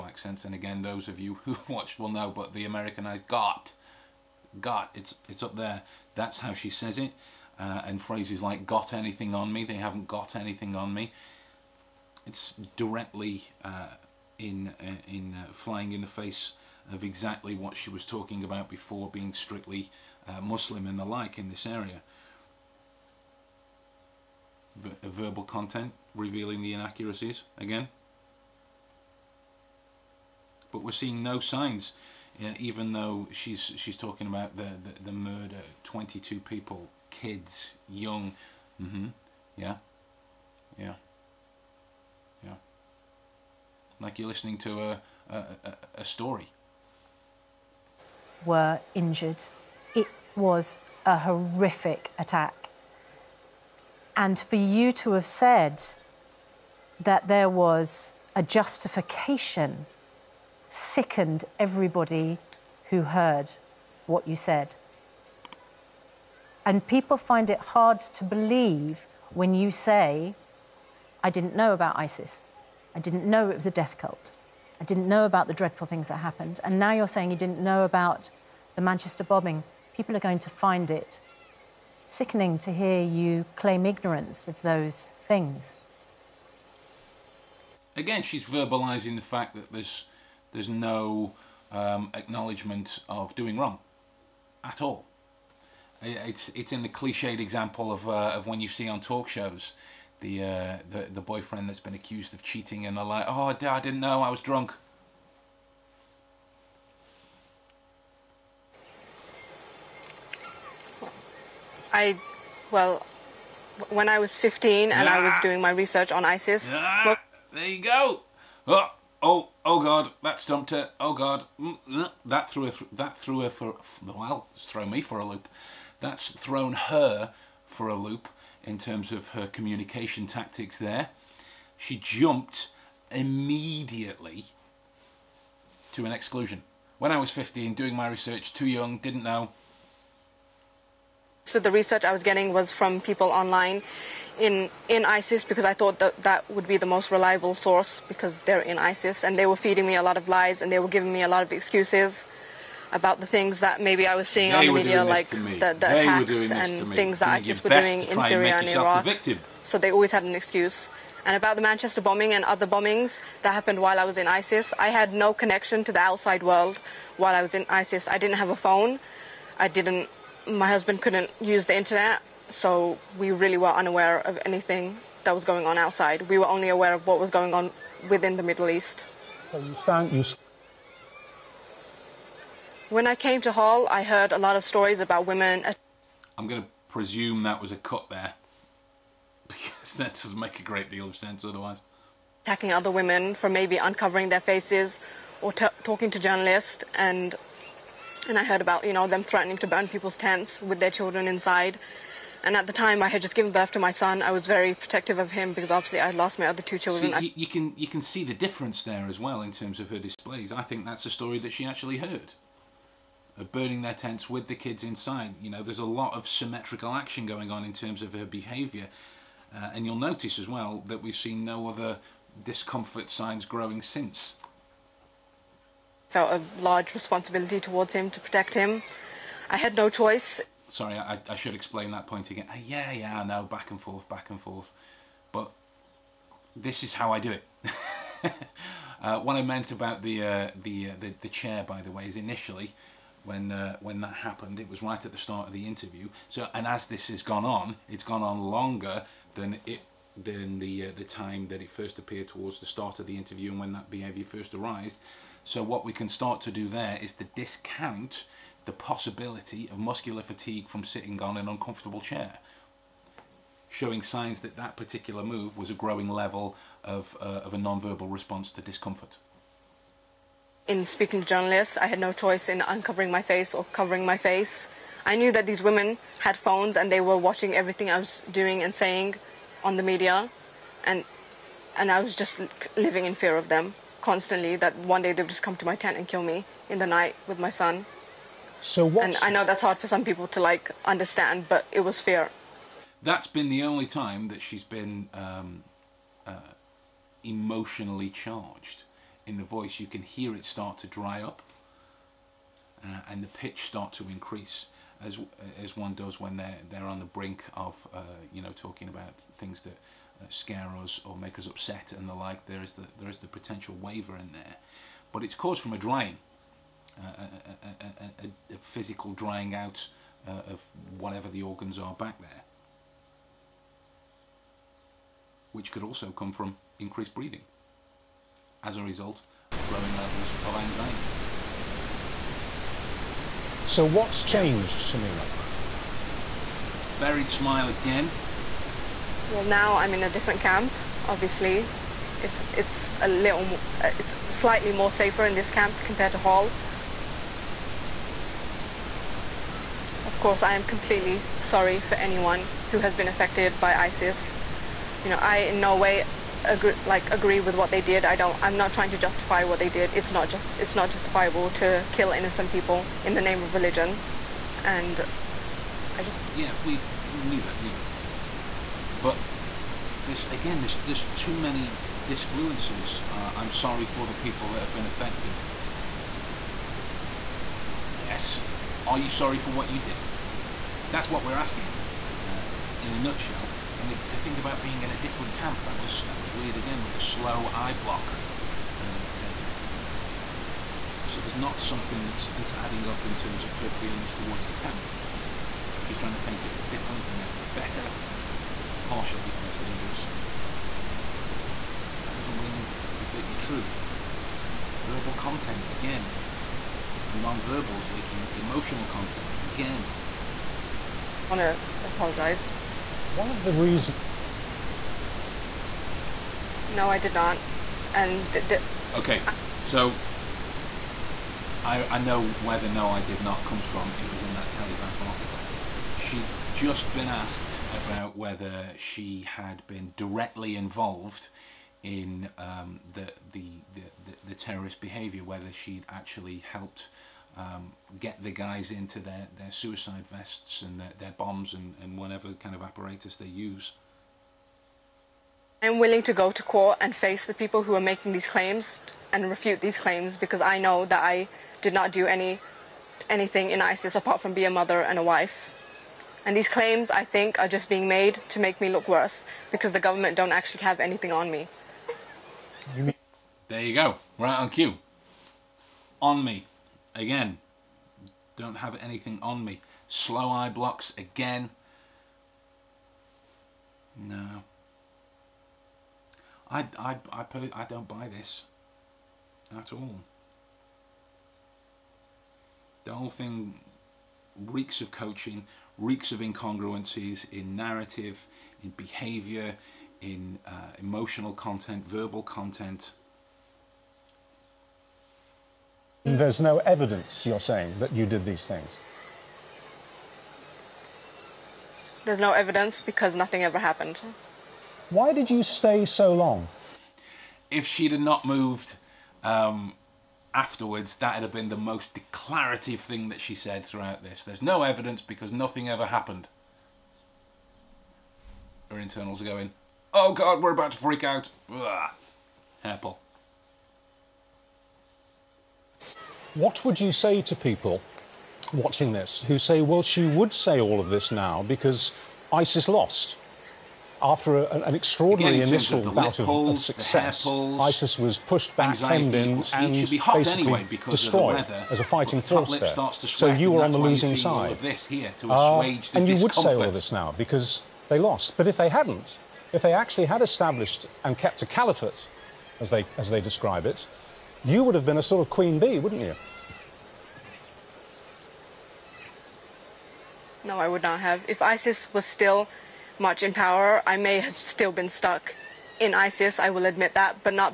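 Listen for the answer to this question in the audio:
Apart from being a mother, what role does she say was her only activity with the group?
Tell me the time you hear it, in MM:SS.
07:34.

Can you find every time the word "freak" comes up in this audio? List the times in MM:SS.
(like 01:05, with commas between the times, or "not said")
08:40.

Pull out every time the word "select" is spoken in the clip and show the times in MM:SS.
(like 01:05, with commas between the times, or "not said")
not said.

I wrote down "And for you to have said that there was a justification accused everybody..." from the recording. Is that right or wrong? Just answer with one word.
wrong.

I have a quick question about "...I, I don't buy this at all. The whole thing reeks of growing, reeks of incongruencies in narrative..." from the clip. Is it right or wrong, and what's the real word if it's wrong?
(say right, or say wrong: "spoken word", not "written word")
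wrong: "coaching", not "growing".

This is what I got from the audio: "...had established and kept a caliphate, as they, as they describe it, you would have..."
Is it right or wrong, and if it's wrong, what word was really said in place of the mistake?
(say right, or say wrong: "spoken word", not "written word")
right.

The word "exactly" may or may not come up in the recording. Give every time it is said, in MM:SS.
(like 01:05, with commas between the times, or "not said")
00:17.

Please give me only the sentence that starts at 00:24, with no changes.
Ver verbal content revealing the inaccuracies again.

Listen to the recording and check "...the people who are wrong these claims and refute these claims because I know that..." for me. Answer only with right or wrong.
wrong.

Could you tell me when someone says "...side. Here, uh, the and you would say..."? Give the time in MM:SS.
09:04.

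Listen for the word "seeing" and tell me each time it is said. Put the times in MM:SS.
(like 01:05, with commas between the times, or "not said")
00:30, 02:34.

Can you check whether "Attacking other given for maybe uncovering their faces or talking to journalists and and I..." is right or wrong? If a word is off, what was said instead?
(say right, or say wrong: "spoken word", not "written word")
wrong: "women", not "given".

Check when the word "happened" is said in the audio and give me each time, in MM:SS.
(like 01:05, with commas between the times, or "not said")
01:16, 02:43, 04:04, 08:23, 08:35.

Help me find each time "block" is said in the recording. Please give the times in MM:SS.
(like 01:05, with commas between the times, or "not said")
06:27, 07:50.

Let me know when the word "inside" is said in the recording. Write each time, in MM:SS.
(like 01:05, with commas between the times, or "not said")
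03:21, 03:34.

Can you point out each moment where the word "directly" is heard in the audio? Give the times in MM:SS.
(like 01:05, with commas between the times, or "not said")
00:12, 07:09.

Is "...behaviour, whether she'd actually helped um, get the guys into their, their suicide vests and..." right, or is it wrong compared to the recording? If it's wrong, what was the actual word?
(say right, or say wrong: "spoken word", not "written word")
right.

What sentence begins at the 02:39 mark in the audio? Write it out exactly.
So they always had an excuse.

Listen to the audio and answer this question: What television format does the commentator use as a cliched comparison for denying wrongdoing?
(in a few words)
talk shows.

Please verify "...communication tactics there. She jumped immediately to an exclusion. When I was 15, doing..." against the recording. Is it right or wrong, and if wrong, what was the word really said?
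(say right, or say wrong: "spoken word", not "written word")
right.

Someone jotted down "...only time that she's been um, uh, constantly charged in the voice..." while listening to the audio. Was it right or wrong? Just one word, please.
wrong.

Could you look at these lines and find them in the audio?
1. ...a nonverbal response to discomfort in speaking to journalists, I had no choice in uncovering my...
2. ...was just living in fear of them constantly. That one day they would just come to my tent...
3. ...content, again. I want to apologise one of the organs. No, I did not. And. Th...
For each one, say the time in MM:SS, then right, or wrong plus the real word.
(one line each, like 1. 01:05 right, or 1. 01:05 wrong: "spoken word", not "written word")
1. 04:27 right
2. 04:42 right
3. 06:48 wrong: "reasons", not "organs".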